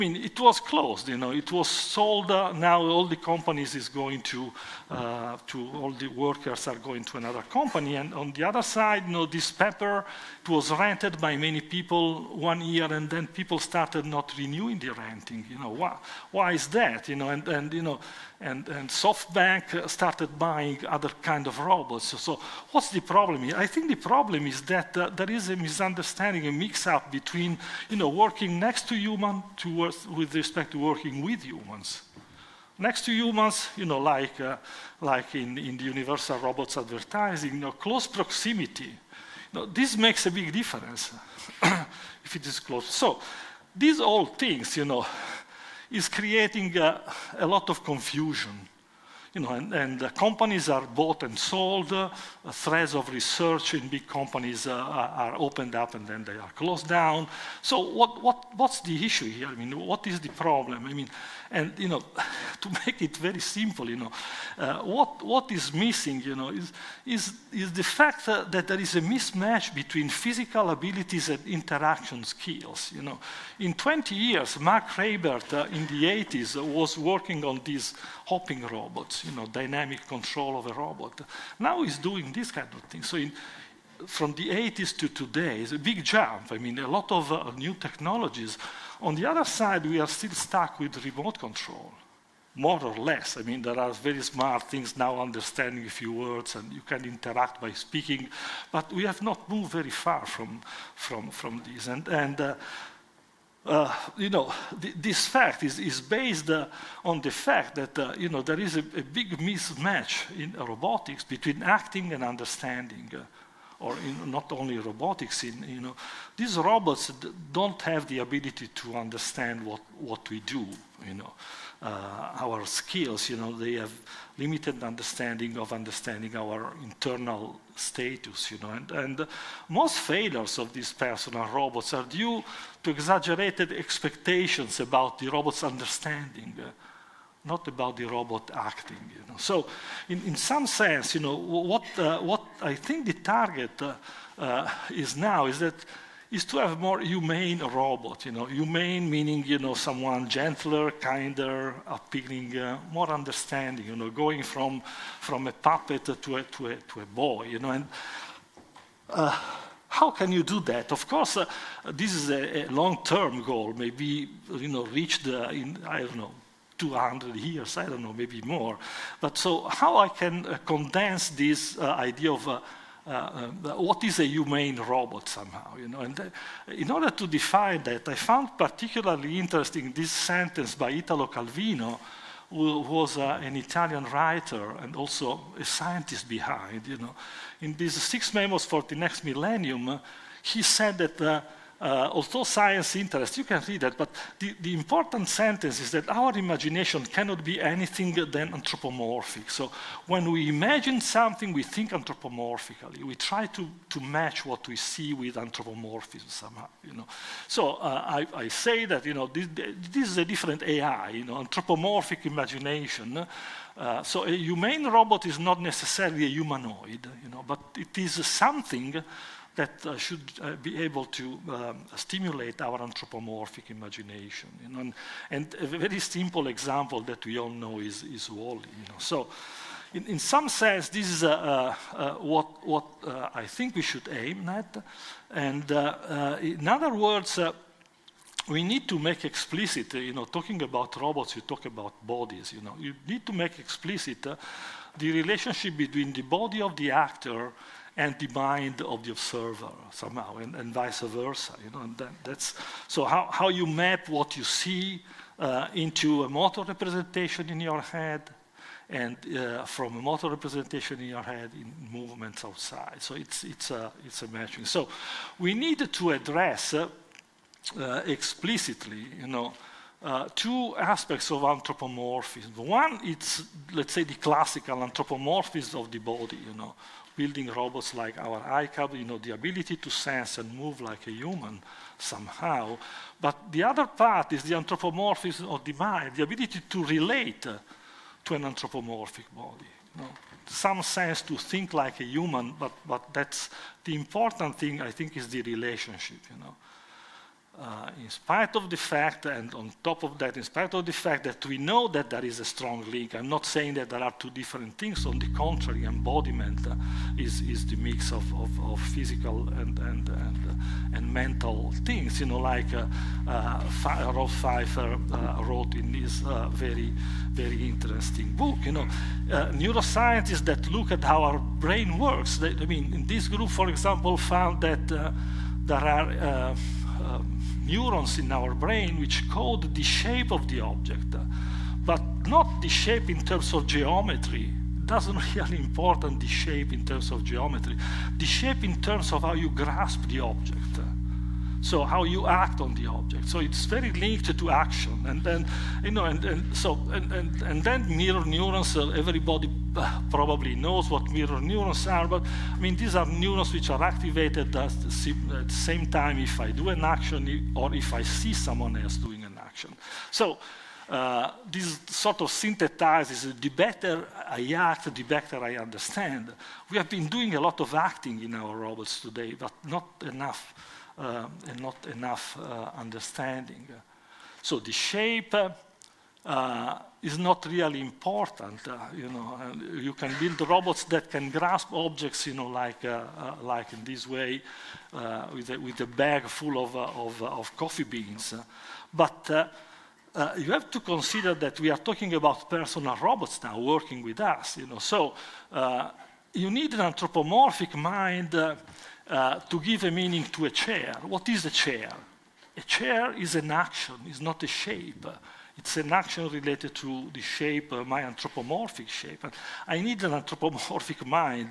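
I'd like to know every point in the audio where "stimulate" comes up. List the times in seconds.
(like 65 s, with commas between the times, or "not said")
221 s.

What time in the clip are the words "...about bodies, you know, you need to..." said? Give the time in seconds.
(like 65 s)
241 s.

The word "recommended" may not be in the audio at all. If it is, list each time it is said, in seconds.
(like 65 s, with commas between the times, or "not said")
not said.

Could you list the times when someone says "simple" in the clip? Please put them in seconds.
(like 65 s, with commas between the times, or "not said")
63 s, 225 s.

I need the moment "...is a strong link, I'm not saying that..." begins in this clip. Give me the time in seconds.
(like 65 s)
302 s.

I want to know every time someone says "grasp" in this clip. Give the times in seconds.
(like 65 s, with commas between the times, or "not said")
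339 s, 381 s.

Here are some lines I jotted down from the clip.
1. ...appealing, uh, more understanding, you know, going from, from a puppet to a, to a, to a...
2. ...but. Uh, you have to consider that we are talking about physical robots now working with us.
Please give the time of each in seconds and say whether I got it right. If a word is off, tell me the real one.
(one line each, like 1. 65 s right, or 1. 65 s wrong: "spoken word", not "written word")
1. 151 s right
2. 388 s wrong: "personal", not "physical".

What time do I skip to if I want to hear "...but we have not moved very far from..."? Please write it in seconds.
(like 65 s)
98 s.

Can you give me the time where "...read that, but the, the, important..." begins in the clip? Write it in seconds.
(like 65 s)
193 s.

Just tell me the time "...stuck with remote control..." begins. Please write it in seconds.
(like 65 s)
90 s.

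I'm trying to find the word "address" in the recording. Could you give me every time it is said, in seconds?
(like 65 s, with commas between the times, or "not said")
266 s.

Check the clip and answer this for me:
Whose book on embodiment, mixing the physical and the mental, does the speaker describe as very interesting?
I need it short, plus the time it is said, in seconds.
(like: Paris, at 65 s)
Rolf Pfeifer, at 314 s.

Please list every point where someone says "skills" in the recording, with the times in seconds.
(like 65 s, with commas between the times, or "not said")
72 s, 122 s.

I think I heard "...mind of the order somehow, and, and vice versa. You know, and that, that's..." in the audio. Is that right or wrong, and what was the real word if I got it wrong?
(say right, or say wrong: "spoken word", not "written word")
wrong: "observer", not "order".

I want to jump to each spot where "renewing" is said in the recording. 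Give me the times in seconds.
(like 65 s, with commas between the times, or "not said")
14 s.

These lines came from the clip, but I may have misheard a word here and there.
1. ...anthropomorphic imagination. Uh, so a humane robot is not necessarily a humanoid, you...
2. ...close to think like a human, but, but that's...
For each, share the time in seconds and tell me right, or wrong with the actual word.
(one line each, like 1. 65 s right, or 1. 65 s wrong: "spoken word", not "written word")
1. 211 s right
2. 290 s wrong: "sense", not "close".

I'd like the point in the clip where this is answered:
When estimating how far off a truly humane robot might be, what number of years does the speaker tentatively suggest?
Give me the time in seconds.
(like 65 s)
166 s.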